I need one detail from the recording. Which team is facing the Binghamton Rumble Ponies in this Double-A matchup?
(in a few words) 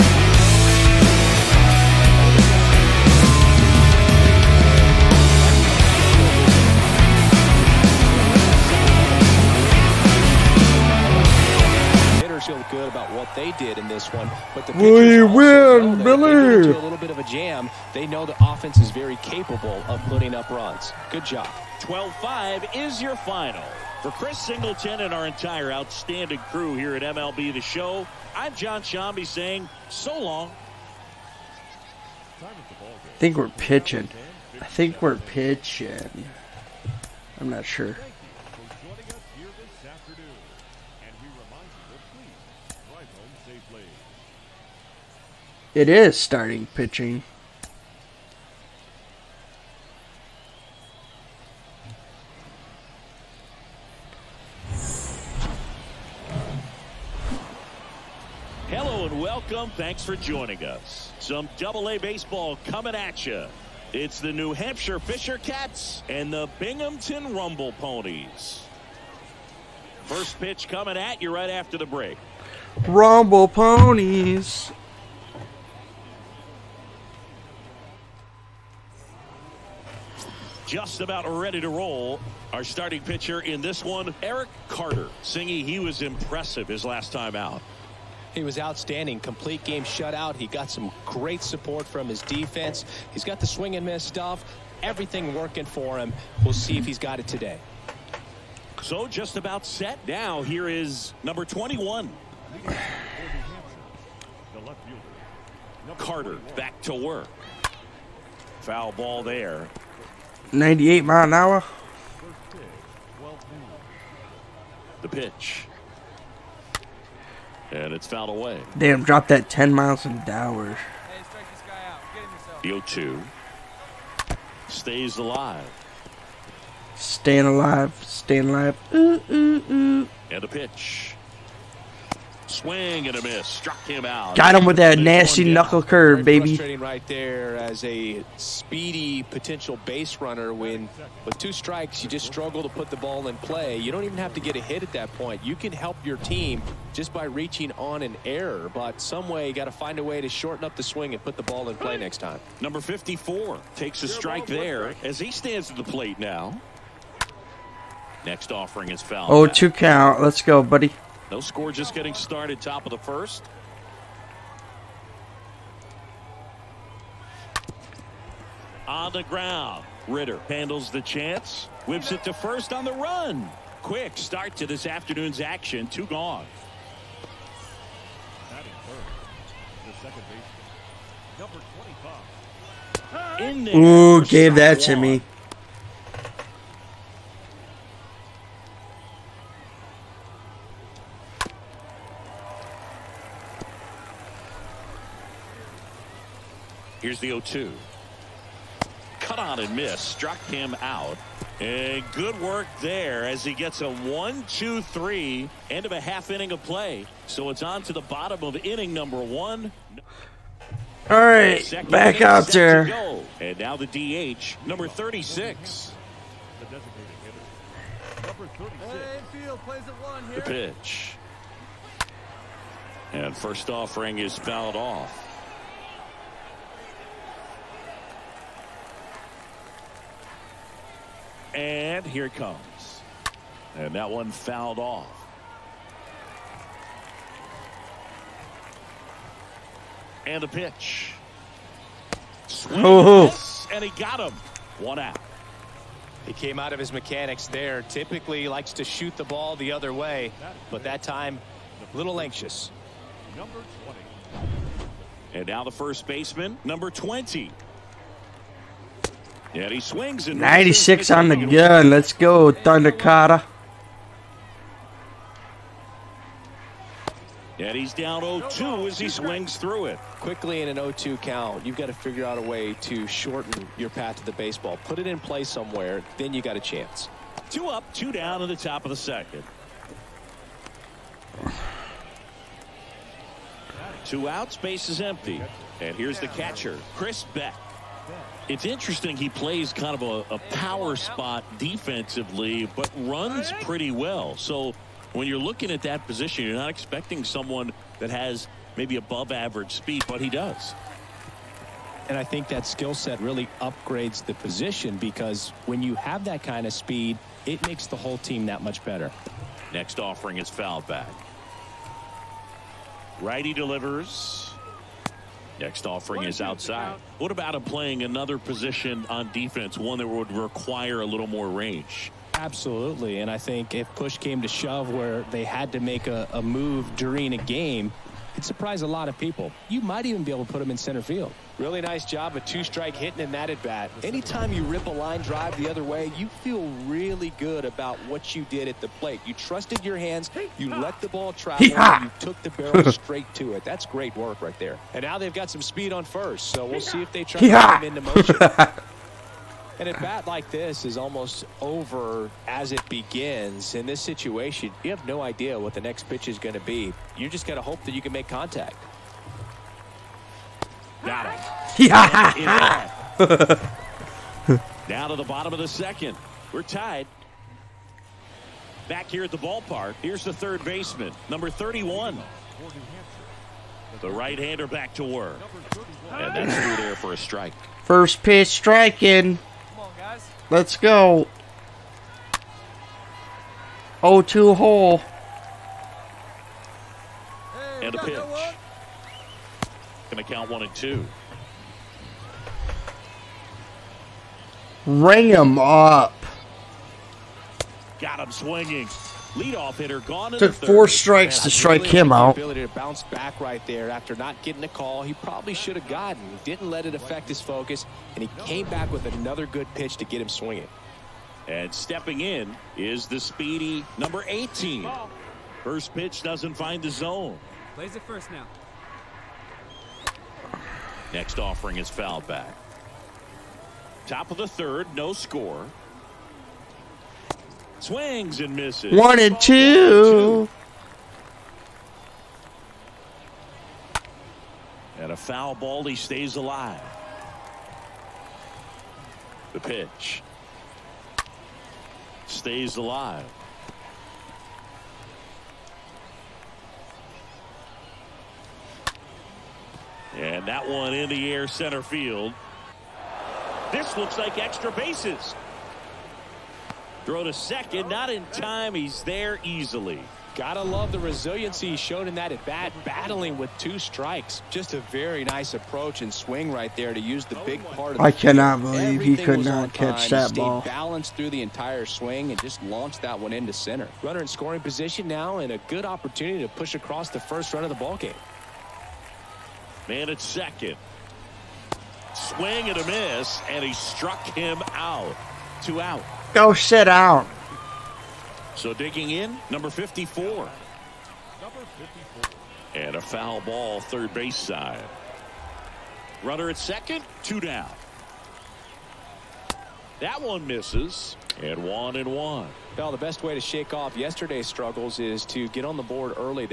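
New Hampshire Fisher Cats.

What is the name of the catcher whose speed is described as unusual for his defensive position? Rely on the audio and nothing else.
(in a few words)
Chris Beck.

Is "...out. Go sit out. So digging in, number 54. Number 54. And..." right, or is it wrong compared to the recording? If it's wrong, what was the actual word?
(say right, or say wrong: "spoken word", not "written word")
right.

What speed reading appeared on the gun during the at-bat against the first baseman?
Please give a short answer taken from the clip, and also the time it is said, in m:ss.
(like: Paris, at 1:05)
96, at 4:20.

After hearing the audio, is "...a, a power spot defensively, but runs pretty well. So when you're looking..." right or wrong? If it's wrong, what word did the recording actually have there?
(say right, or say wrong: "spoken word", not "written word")
right.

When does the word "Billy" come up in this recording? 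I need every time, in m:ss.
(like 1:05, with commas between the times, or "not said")
0:16.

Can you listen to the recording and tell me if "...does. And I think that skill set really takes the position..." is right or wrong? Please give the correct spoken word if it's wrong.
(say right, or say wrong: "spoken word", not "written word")
wrong: "upgrades", not "takes".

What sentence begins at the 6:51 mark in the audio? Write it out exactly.
And stepping in is the speedy number 18.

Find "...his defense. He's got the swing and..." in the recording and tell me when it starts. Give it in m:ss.
1:32.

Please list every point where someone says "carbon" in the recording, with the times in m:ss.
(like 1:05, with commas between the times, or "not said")
not said.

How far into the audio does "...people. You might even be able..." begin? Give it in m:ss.
5:29.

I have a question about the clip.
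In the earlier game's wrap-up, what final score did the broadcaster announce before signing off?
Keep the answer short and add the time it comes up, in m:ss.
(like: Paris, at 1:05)
12-5, at 0:21.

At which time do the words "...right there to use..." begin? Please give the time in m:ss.
7:46.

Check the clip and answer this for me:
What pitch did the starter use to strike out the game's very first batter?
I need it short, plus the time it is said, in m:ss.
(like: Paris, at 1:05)
knuckle curve, at 2:15.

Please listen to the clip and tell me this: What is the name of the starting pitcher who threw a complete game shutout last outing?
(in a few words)
Eric Carter.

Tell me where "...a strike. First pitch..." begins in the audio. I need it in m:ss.
6:17.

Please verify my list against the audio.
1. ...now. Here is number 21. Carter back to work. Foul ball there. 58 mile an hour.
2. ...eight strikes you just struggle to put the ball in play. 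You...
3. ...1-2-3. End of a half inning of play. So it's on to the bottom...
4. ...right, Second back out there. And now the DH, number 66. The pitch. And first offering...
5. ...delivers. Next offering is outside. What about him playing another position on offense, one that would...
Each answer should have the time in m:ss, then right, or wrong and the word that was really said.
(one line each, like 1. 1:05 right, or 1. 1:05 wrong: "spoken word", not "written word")
1. 1:40 wrong: "98", not "58"
2. 2:21 wrong: "two", not "eight"
3. 3:23 right
4. 3:31 wrong: "36", not "66"
5. 5:13 wrong: "defense", not "offense".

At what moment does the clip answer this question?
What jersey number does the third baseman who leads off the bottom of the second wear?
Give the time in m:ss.
6:11.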